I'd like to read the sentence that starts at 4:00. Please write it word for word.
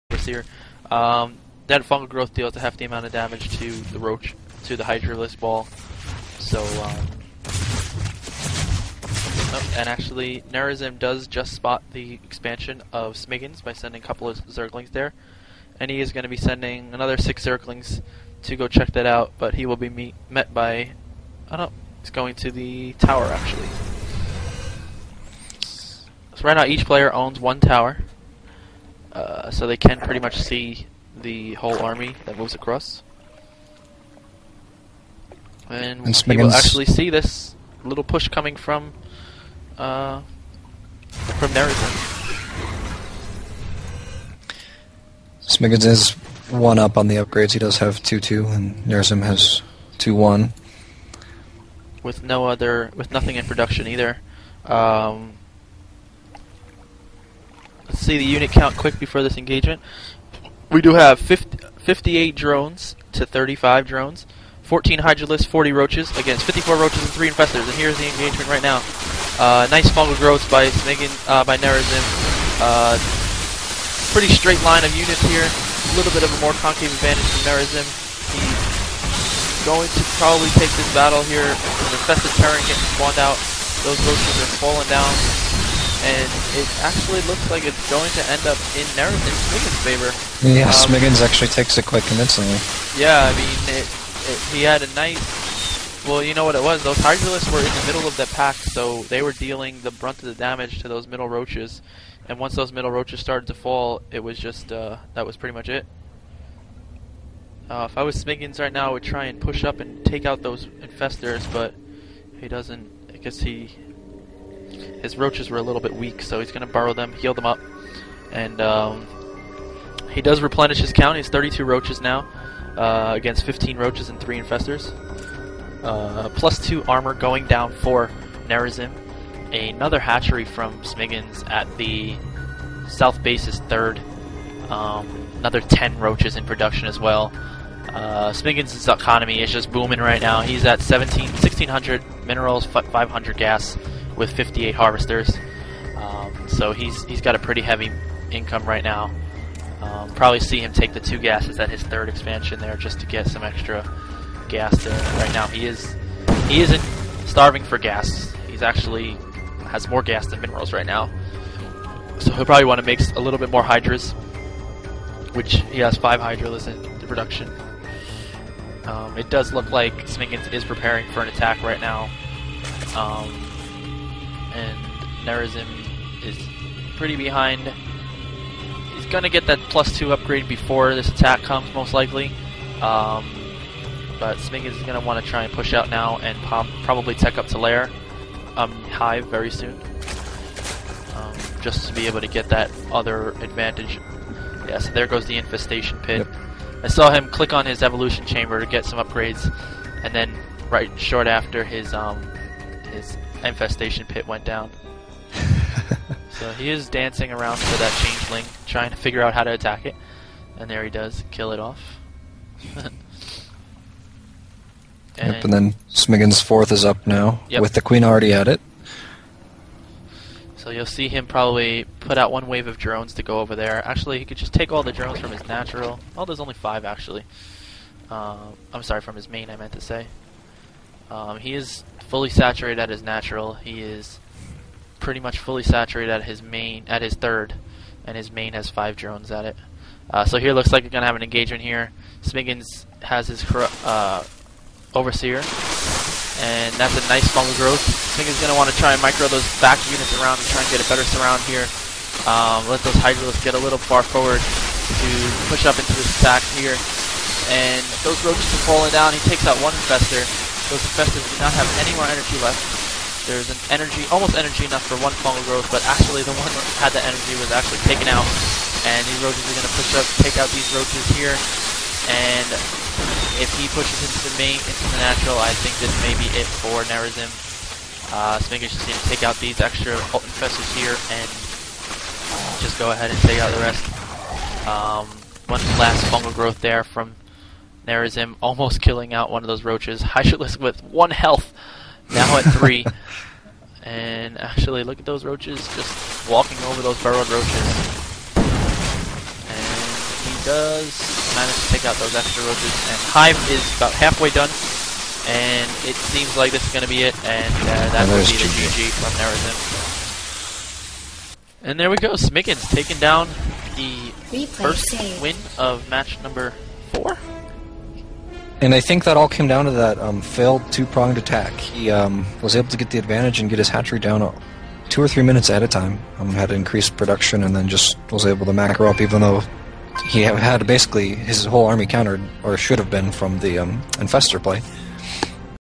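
Uh, so here looks like we are gonna have an engagement here.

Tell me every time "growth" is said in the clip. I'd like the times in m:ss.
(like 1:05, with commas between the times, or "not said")
0:02, 1:10, 4:07, 4:25, 4:46.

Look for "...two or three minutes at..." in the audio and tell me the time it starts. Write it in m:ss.
5:24.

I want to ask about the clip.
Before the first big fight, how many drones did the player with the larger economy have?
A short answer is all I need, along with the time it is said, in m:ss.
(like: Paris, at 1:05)
58, at 1:01.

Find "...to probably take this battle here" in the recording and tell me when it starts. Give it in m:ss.
1:19.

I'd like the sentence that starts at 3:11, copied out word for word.
Um, just to be able to get that other advantage.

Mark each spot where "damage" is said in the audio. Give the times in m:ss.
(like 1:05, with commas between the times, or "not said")
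0:03, 1:40.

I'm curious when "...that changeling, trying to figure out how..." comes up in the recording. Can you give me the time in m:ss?
3:27.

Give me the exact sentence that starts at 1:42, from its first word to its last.
And once those middle roaches started to fall, it was just, uh, that was pretty much it.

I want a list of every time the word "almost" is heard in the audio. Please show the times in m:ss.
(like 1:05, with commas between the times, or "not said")
4:24, 4:48.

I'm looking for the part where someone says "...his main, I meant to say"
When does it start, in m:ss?
3:49.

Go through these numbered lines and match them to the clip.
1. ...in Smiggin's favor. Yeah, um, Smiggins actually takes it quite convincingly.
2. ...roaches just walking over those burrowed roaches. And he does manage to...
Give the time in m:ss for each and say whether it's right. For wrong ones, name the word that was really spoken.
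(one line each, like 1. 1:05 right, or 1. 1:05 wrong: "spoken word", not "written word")
1. 1:29 right
2. 4:55 right.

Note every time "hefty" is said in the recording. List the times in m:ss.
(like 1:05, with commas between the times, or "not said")
0:02.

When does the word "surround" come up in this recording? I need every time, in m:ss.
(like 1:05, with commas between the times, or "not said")
4:11.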